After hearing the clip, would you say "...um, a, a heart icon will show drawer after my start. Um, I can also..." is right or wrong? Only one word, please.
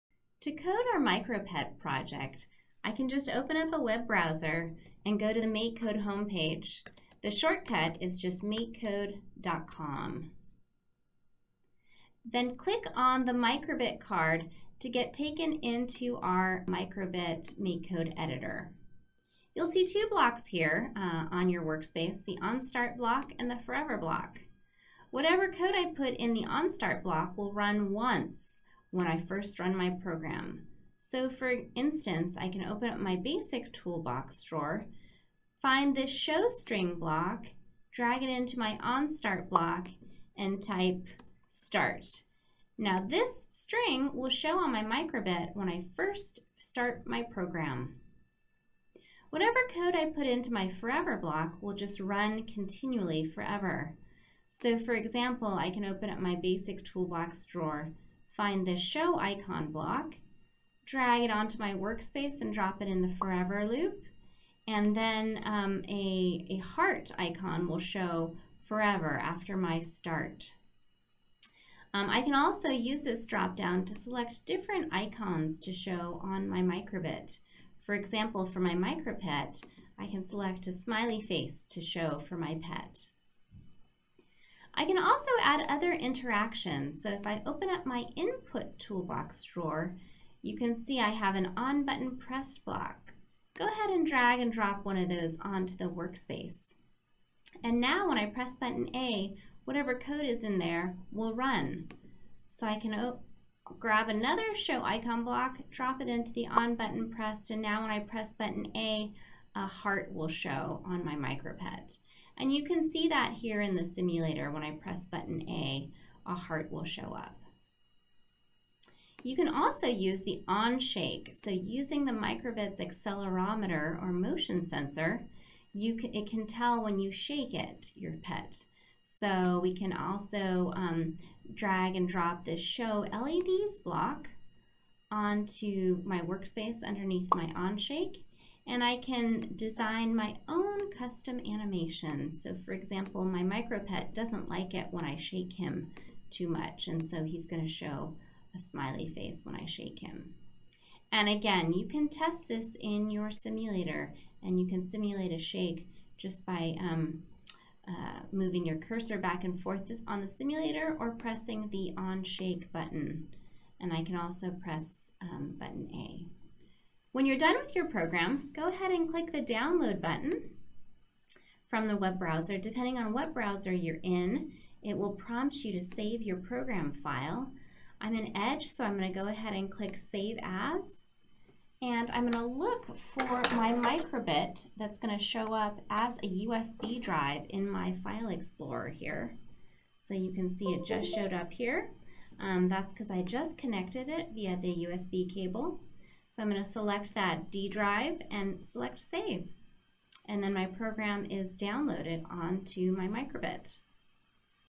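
wrong.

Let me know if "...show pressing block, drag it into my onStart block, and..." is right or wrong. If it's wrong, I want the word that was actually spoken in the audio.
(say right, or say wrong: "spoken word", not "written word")
wrong: "string", not "pressing".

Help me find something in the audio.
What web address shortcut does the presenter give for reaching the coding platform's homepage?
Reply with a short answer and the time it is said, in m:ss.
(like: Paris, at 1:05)
makecode.com, at 0:08.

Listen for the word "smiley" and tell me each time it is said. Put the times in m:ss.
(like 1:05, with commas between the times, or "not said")
1:20, 2:28.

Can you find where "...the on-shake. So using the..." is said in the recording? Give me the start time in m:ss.
2:00.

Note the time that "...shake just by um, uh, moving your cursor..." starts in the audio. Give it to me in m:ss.
2:35.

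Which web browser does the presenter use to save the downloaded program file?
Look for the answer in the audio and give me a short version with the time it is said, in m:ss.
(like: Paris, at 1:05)
Edge, at 2:58.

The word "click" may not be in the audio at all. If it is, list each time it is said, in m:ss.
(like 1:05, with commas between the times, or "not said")
0:12, 2:49, 2:59.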